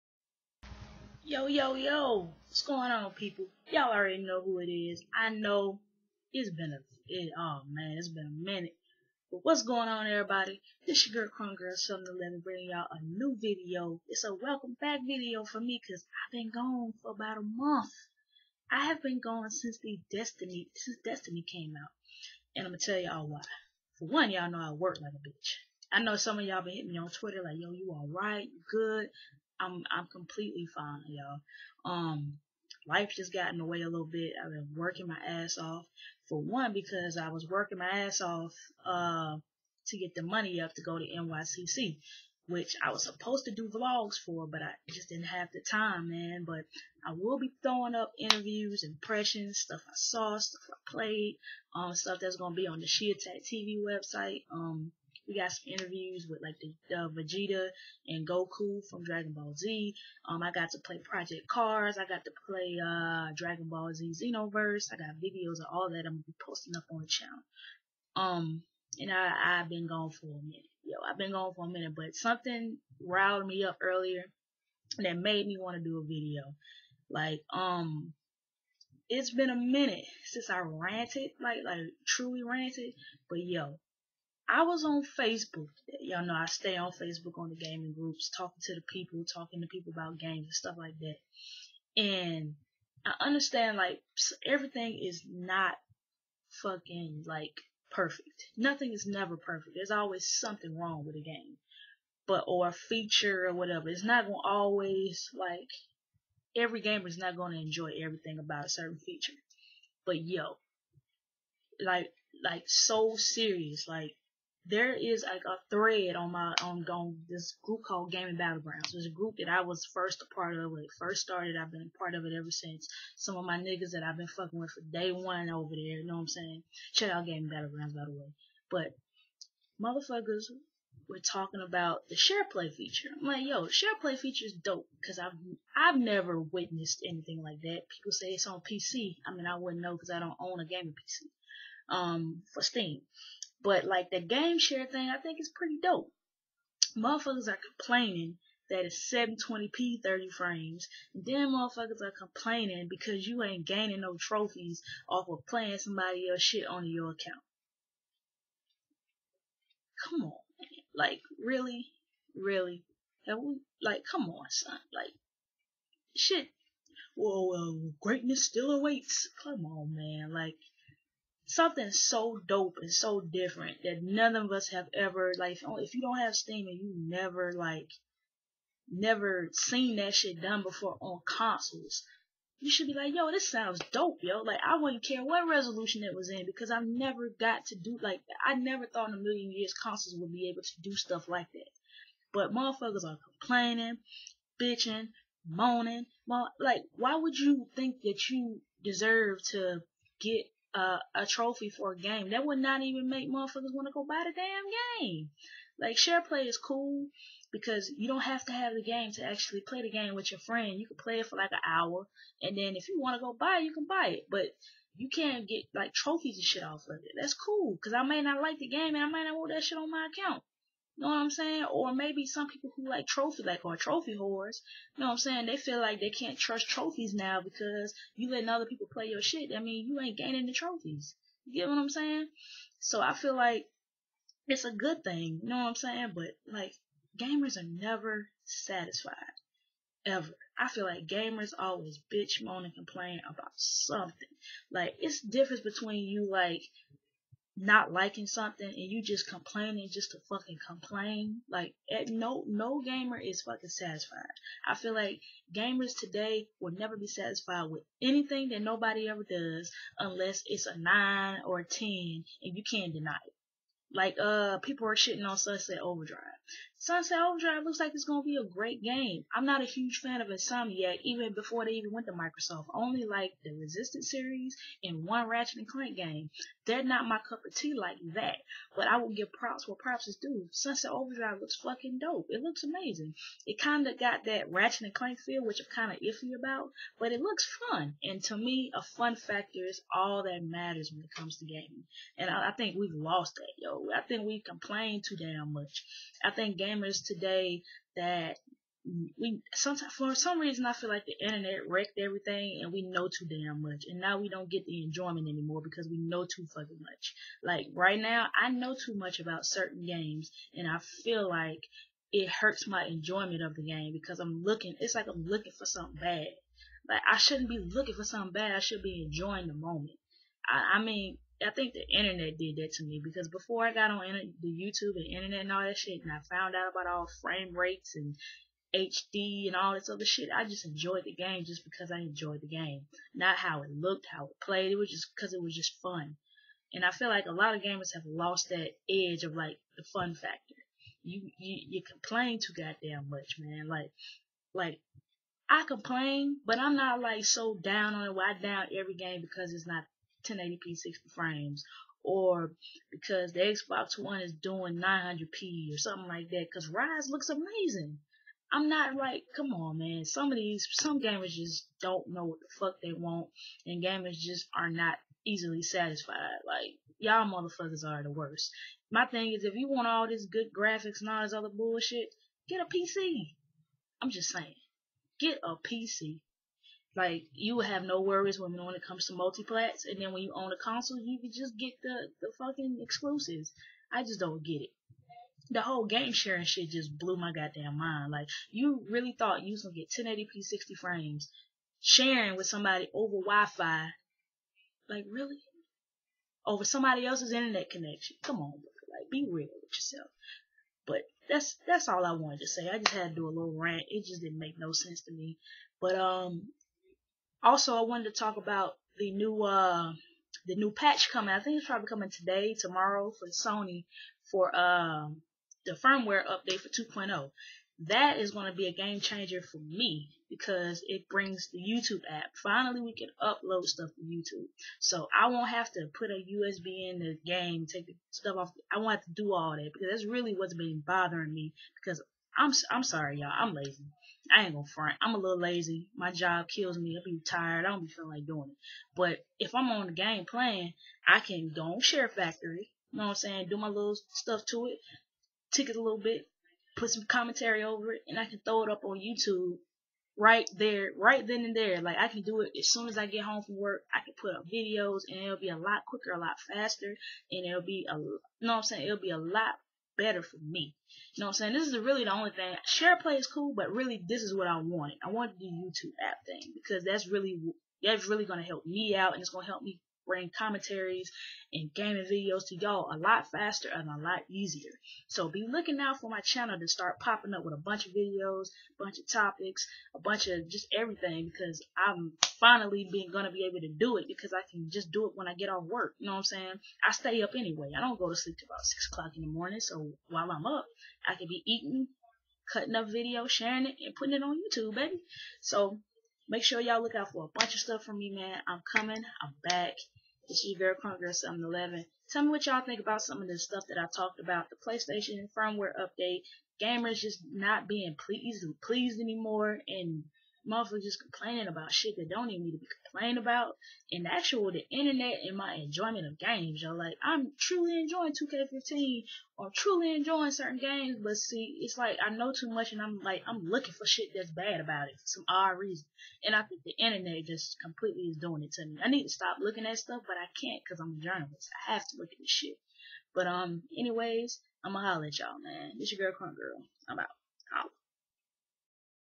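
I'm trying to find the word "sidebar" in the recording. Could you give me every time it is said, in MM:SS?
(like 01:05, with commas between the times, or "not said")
not said.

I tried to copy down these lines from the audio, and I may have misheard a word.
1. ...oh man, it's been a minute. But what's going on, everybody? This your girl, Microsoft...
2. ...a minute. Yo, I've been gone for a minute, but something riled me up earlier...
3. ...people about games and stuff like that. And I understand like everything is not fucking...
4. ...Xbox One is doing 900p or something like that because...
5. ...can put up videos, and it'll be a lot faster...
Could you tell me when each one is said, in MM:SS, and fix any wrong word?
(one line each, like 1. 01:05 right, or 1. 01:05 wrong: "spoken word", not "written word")
1. 00:07 wrong: "Crunk", not "Microsoft"
2. 01:10 right
3. 01:29 right
4. 05:53 right
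5. 07:34 wrong: "quicker", not "faster".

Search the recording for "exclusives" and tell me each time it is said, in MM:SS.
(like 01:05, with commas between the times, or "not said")
06:22.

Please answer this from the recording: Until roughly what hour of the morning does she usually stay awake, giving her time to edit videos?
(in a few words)
6.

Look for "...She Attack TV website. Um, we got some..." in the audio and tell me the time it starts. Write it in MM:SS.
00:52.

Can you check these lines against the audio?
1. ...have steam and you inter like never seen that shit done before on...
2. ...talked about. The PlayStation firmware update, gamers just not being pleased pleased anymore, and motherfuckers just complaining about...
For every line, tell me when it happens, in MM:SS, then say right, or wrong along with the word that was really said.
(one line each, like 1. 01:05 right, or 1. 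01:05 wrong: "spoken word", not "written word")
1. 02:56 wrong: "never", not "inter"
2. 08:23 right.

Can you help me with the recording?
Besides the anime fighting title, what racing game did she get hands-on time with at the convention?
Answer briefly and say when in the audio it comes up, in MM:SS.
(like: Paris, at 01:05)
Project Cars, at 01:01.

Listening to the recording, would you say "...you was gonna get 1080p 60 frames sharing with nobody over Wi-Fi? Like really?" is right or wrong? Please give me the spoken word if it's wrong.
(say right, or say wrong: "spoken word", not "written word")
wrong: "somebody", not "nobody".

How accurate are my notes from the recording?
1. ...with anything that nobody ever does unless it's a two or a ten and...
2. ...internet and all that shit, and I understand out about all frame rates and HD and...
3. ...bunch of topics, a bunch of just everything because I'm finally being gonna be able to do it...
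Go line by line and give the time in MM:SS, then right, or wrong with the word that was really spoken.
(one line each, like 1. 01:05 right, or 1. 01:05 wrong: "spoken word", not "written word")
1. 04:17 wrong: "nine", not "two"
2. 05:25 wrong: "found", not "understand"
3. 07:58 right.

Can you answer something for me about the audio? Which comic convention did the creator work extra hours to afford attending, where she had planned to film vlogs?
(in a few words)
NYCC.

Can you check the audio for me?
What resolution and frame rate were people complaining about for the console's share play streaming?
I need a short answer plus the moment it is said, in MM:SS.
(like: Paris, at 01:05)
720p 30 frames, at 02:29.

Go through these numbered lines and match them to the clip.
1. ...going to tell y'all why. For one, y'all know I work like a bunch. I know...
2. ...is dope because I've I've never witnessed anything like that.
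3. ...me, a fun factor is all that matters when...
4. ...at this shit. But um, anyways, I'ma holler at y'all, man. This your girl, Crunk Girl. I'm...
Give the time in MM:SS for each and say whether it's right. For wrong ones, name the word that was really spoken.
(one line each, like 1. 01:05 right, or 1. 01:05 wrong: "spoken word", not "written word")
1. 00:22 wrong: "bitch", not "bunch"
2. 02:14 right
3. 04:48 right
4. 08:52 right.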